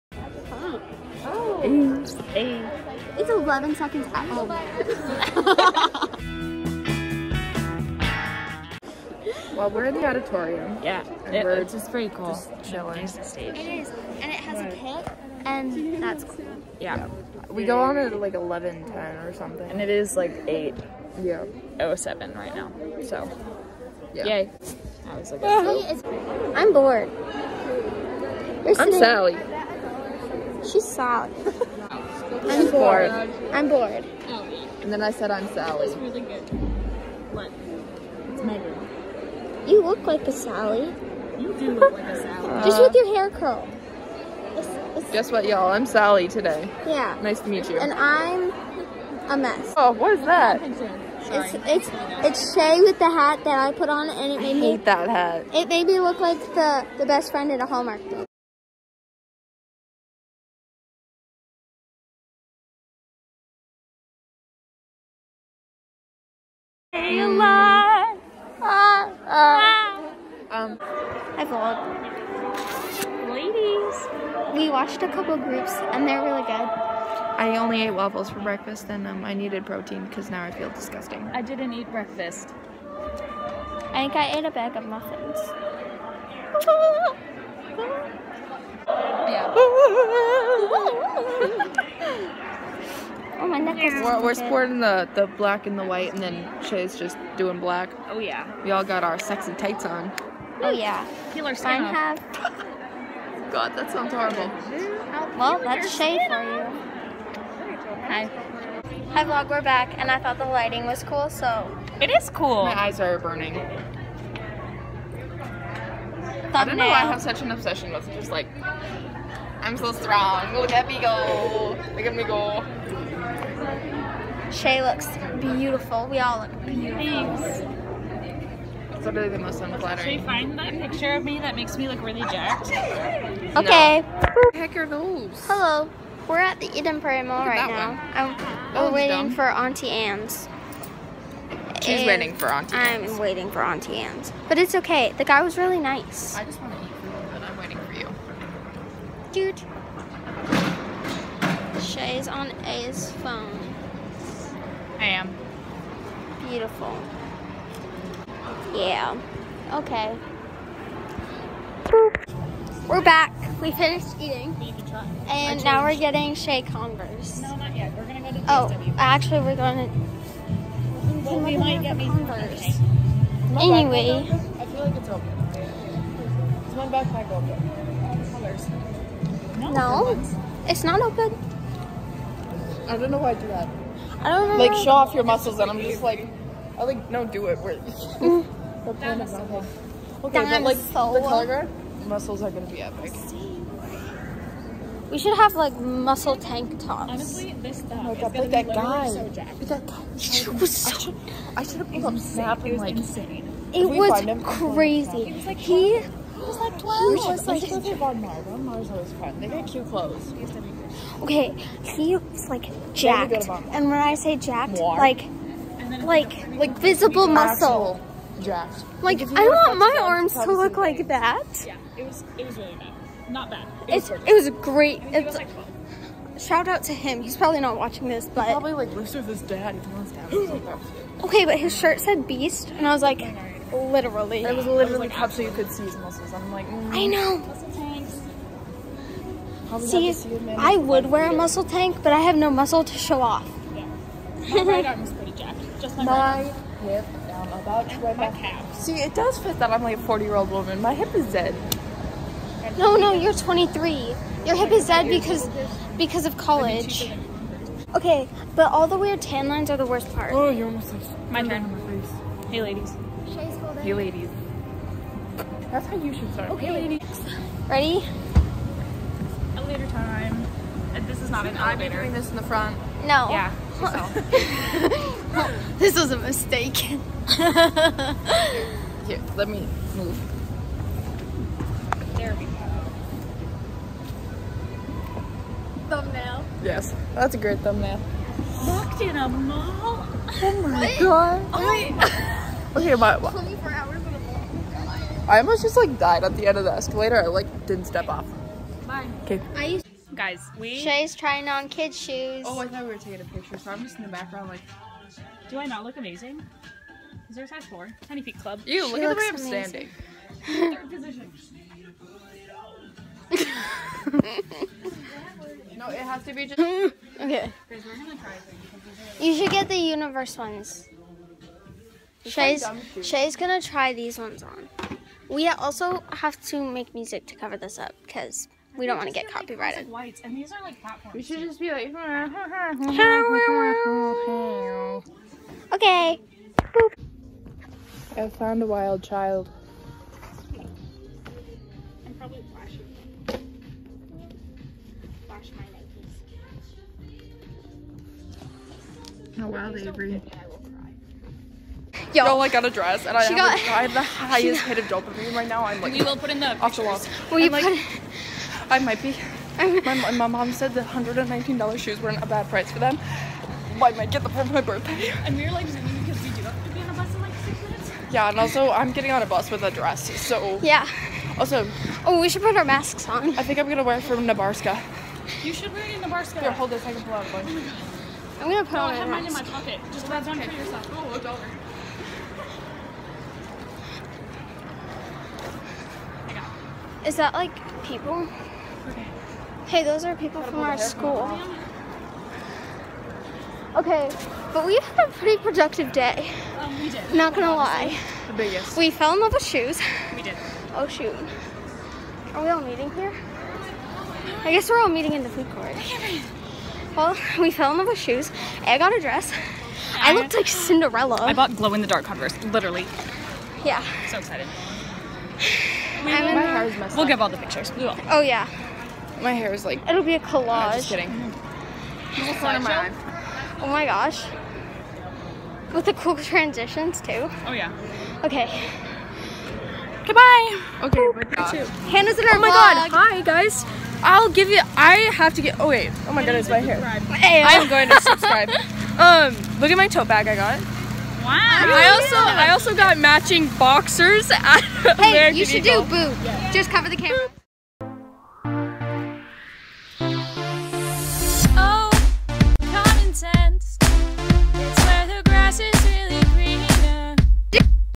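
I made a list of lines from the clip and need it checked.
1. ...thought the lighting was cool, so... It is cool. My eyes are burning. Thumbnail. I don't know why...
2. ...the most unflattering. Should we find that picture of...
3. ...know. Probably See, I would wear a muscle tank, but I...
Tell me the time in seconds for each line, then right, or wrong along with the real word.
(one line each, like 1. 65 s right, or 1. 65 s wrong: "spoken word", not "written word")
1. 110 s right
2. 129 s right
3. 237 s right.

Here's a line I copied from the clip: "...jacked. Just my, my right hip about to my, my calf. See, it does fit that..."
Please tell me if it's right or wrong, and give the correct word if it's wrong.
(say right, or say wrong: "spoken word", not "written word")
right.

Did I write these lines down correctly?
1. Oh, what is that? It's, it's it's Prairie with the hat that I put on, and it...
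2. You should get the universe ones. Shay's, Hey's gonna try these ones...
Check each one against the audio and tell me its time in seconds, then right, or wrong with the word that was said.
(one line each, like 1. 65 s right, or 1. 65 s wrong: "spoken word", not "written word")
1. 49 s wrong: "Shay", not "Prairie"
2. 319 s wrong: "Shay", not "Hey".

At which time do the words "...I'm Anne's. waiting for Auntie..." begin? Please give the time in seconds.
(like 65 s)
142 s.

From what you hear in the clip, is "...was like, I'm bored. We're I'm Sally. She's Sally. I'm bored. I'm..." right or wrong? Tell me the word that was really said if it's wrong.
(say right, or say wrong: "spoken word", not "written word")
right.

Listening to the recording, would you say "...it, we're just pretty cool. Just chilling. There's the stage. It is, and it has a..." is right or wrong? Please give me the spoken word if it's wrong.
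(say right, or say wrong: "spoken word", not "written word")
right.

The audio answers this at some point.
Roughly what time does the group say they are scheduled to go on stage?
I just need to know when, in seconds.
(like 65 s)
18 s.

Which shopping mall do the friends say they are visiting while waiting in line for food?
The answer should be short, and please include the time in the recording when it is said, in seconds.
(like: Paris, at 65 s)
Eden Prairie Mall, at 136 s.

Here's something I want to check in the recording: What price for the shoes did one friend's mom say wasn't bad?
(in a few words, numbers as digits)
$119.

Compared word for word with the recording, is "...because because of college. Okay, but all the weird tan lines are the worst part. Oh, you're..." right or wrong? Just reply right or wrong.
right.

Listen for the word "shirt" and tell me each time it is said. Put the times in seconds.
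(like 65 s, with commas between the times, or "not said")
231 s.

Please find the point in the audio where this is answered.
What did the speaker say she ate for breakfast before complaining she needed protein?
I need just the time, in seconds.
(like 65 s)
77 s.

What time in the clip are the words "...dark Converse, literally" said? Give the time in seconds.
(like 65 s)
411 s.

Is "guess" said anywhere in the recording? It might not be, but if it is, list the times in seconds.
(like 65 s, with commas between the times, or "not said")
45 s, 404 s.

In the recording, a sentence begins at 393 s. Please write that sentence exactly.
Okay, but we had a pretty productive day.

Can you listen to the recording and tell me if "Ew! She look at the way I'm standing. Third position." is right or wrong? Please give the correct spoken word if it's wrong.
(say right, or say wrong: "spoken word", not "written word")
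right.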